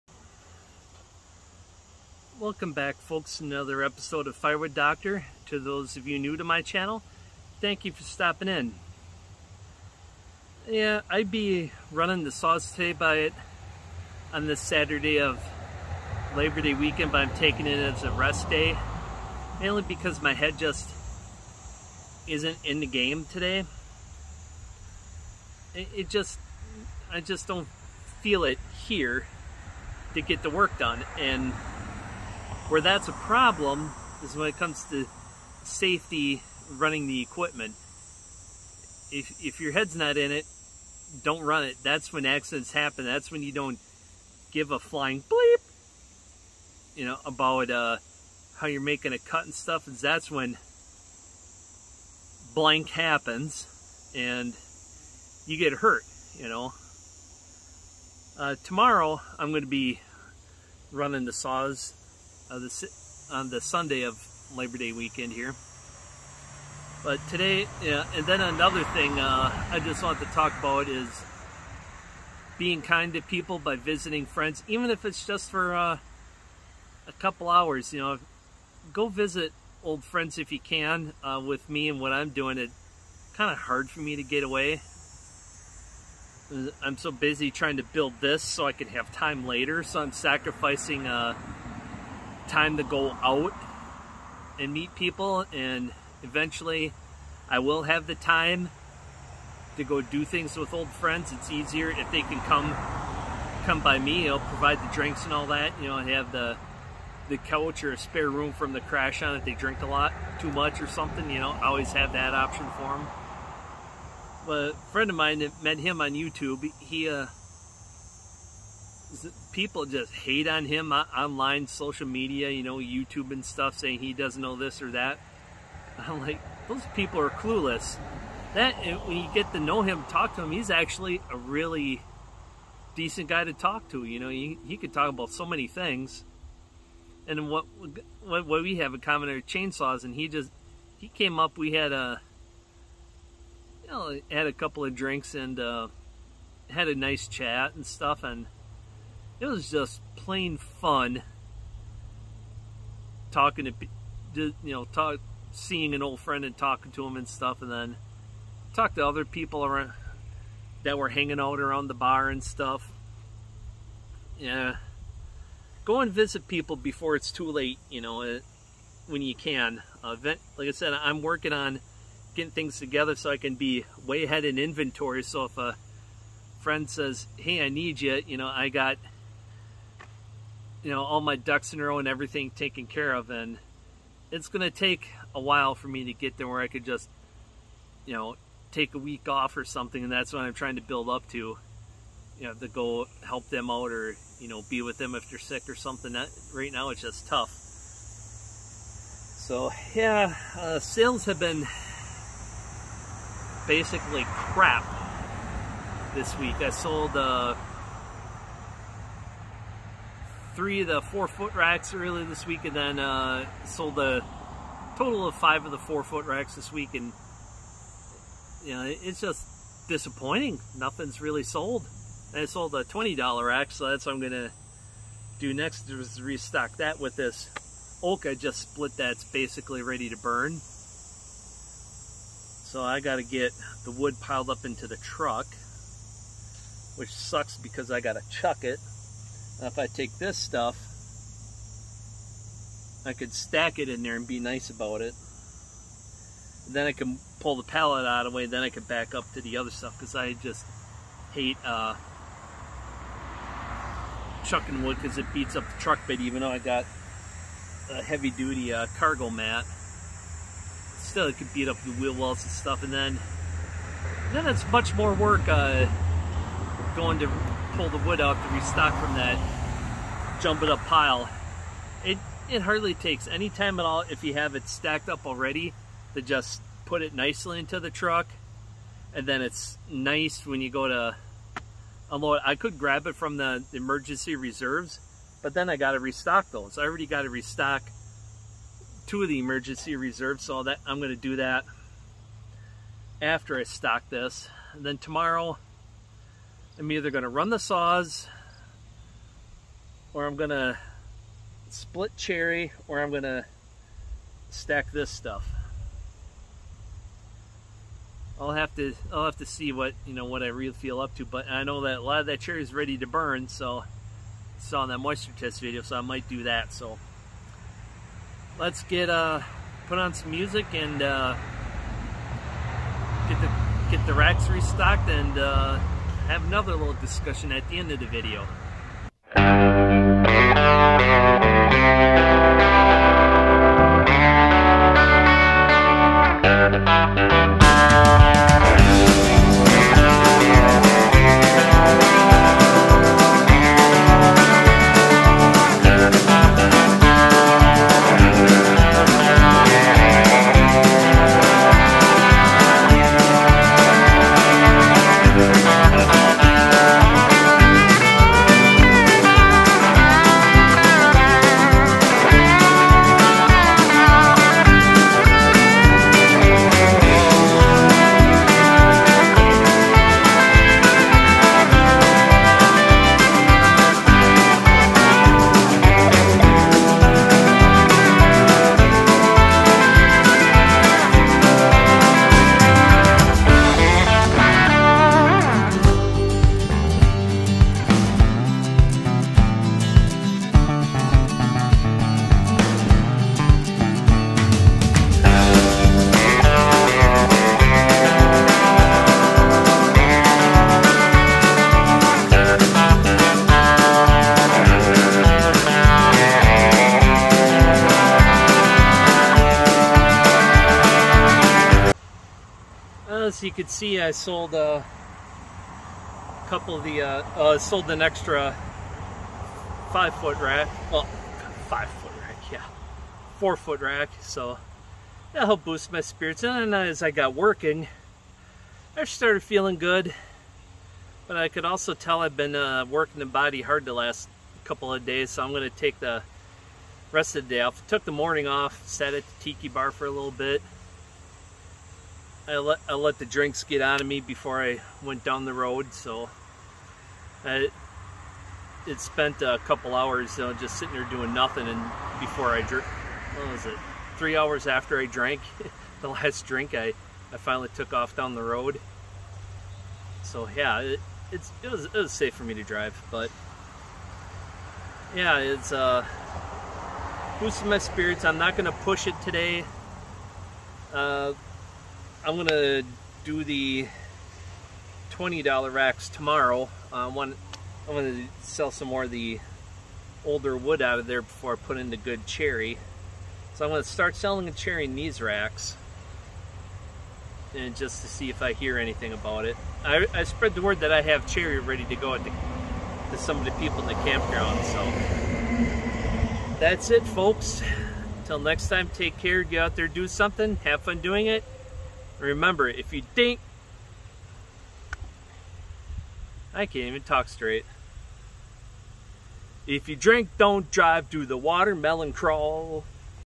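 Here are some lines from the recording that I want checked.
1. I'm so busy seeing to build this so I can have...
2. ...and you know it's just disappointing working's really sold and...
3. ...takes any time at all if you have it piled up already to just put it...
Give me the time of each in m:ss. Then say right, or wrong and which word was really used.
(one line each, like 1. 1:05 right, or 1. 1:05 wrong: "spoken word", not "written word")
1. 1:26 wrong: "trying", not "seeing"
2. 3:36 wrong: "nothing", not "working"
3. 4:32 wrong: "stacked", not "piled".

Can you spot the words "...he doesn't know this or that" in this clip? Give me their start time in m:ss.
2:03.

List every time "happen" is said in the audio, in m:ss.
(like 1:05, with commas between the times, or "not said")
0:42, 0:52.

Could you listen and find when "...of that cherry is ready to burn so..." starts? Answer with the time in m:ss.
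5:12.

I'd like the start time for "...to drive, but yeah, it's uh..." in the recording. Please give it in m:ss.
7:42.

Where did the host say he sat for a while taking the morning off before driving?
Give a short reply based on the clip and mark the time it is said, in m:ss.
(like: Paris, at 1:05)
tiki bar, at 7:19.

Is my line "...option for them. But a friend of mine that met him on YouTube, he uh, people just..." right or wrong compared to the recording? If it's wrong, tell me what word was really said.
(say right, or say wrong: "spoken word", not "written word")
right.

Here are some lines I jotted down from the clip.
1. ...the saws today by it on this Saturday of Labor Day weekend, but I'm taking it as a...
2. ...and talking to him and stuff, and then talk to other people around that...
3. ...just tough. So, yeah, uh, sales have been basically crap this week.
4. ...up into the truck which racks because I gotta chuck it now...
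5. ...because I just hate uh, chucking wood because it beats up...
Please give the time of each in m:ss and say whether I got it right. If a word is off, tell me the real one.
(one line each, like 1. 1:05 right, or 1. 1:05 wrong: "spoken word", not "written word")
1. 0:12 right
2. 2:36 right
3. 3:17 right
4. 3:54 wrong: "sucks", not "racks"
5. 4:09 right.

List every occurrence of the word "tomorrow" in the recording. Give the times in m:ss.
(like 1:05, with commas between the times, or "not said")
0:58, 4:54, 7:56.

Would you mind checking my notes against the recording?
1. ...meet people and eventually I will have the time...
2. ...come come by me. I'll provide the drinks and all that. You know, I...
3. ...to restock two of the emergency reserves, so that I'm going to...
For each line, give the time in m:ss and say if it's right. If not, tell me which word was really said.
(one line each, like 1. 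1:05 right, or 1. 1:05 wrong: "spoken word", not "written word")
1. 1:34 right
2. 1:42 right
3. 4:47 right.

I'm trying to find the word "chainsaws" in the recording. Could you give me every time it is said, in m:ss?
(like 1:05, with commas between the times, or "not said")
2:19.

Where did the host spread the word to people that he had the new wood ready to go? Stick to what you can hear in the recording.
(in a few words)
the campground.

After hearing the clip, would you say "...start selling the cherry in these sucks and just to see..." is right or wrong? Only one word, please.
wrong.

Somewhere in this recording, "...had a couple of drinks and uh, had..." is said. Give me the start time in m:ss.
2:24.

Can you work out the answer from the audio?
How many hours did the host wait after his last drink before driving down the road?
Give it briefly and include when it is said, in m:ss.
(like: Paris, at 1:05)
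3, at 7:34.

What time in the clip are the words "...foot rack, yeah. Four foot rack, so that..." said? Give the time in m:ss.
7:01.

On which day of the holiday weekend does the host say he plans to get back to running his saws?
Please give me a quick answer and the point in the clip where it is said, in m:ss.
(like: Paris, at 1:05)
Sunday, at 1:03.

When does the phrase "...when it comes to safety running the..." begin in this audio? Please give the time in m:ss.
0:34.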